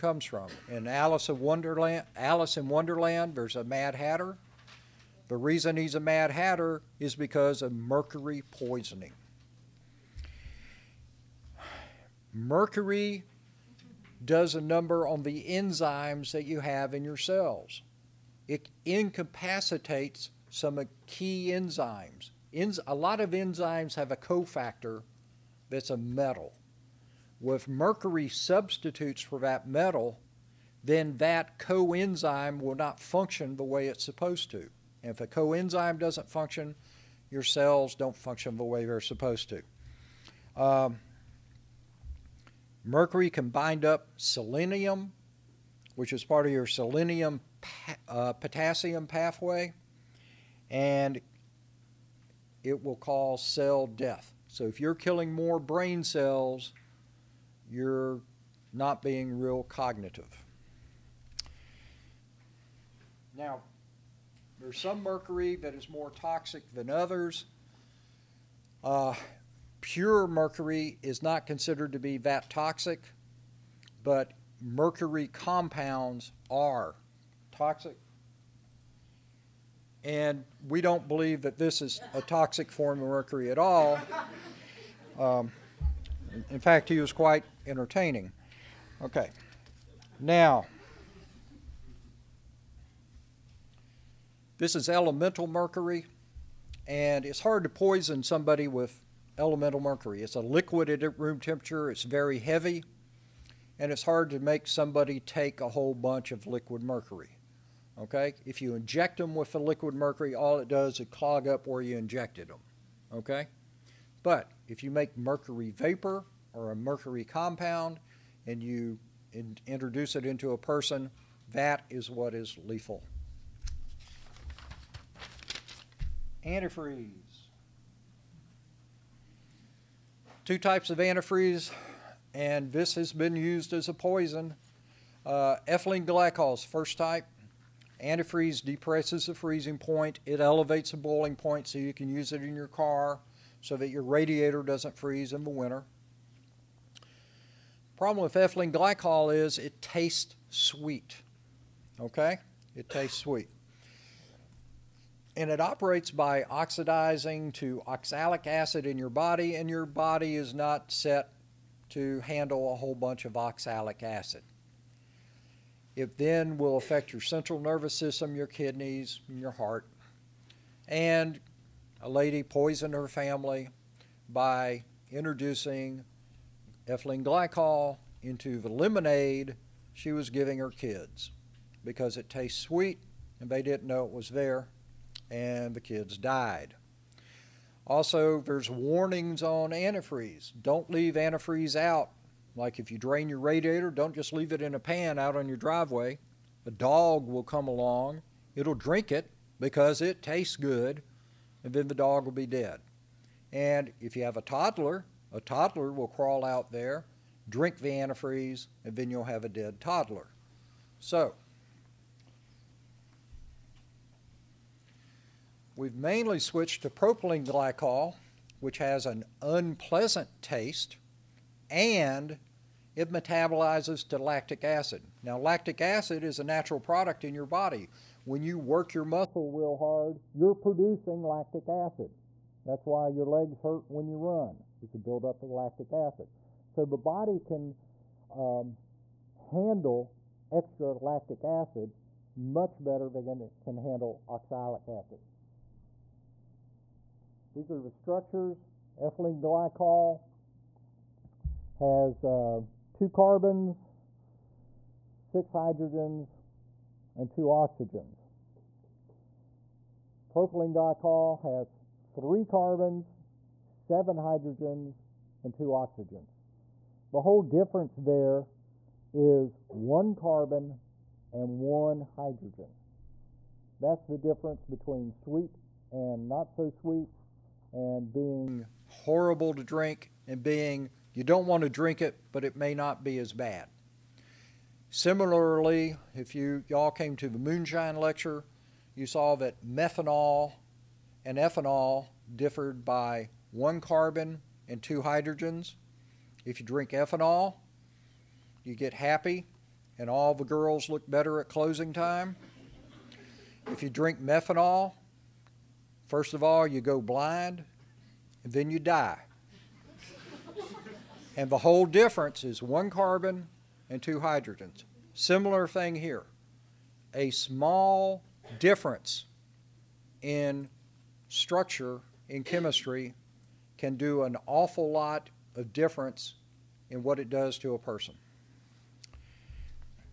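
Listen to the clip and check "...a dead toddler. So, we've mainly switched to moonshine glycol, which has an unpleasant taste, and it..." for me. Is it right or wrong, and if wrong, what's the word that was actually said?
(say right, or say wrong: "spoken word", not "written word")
wrong: "propylene", not "moonshine".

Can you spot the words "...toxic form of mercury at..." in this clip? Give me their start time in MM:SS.
01:22.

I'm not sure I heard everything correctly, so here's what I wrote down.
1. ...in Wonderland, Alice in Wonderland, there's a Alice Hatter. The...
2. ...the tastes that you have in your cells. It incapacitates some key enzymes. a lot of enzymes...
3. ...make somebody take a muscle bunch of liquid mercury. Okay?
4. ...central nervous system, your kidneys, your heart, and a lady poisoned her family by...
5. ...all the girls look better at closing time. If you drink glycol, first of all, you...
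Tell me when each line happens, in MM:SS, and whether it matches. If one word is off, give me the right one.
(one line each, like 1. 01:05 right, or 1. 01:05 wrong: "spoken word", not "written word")
1. 00:01 wrong: "Mad", not "Alice"
2. 00:15 wrong: "enzymes", not "tastes"
3. 01:44 wrong: "whole", not "muscle"
4. 02:47 right
5. 05:00 wrong: "methanol", not "glycol".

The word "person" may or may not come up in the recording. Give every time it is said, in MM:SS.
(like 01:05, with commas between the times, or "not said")
02:00, 05:27.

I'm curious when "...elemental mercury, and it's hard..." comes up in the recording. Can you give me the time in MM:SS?
01:34.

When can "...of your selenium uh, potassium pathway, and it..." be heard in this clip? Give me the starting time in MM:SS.
00:46.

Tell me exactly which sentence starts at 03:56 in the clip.
So the body can um, handle extra lactic acid much better than it can handle oxalic acid.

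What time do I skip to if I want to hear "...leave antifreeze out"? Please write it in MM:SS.
03:10.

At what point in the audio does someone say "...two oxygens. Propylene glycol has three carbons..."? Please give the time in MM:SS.
04:17.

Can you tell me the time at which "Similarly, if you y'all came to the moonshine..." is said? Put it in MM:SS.
04:44.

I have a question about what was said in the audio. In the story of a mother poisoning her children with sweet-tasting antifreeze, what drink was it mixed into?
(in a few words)
lemonade.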